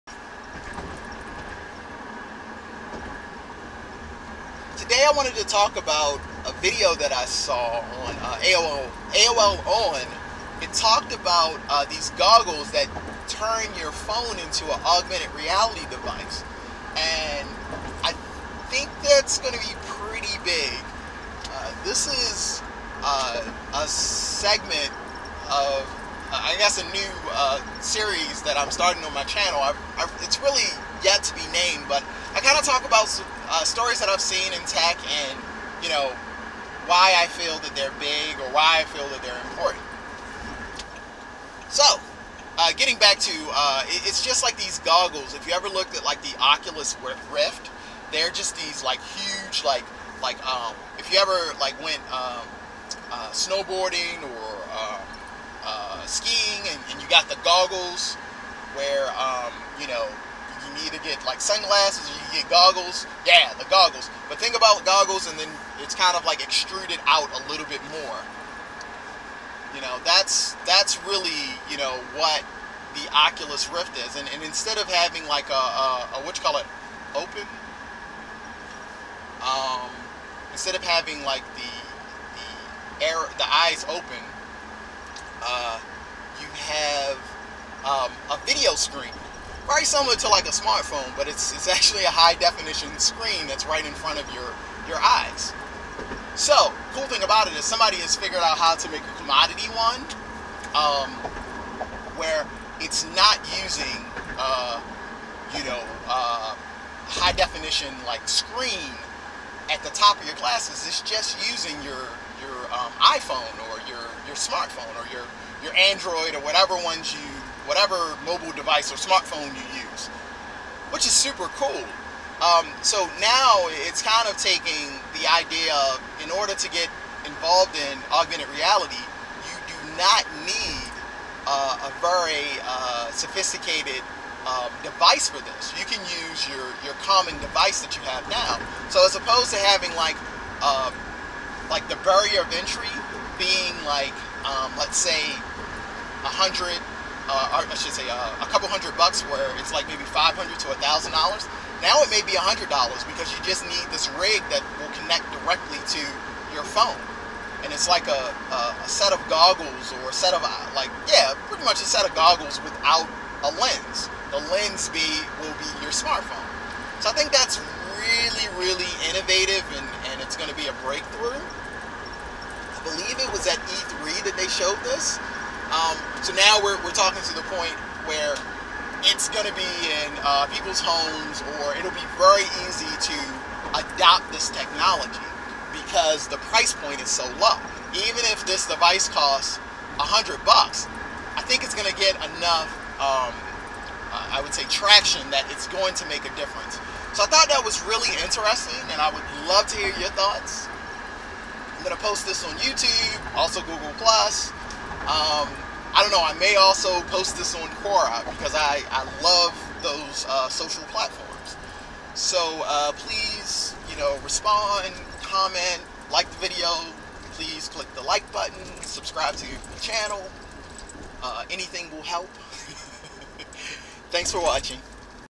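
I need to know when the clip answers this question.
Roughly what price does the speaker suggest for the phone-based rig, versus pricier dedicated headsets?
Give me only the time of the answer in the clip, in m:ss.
2:32.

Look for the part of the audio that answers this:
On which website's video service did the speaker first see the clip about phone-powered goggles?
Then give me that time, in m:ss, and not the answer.
0:08.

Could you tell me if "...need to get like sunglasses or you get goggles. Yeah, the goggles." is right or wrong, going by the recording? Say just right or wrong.
right.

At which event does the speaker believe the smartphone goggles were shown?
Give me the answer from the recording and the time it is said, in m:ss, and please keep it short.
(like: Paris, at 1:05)
E3, at 2:53.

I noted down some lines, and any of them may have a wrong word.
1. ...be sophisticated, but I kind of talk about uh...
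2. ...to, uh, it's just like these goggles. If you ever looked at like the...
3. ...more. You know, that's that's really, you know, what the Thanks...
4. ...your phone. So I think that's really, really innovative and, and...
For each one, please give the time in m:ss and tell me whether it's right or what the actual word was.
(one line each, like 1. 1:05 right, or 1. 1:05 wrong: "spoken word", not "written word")
1. 0:31 wrong: "named", not "sophisticated"
2. 0:43 right
3. 1:07 wrong: "Oculus", not "Thanks"
4. 2:45 wrong: "smartphone", not "phone".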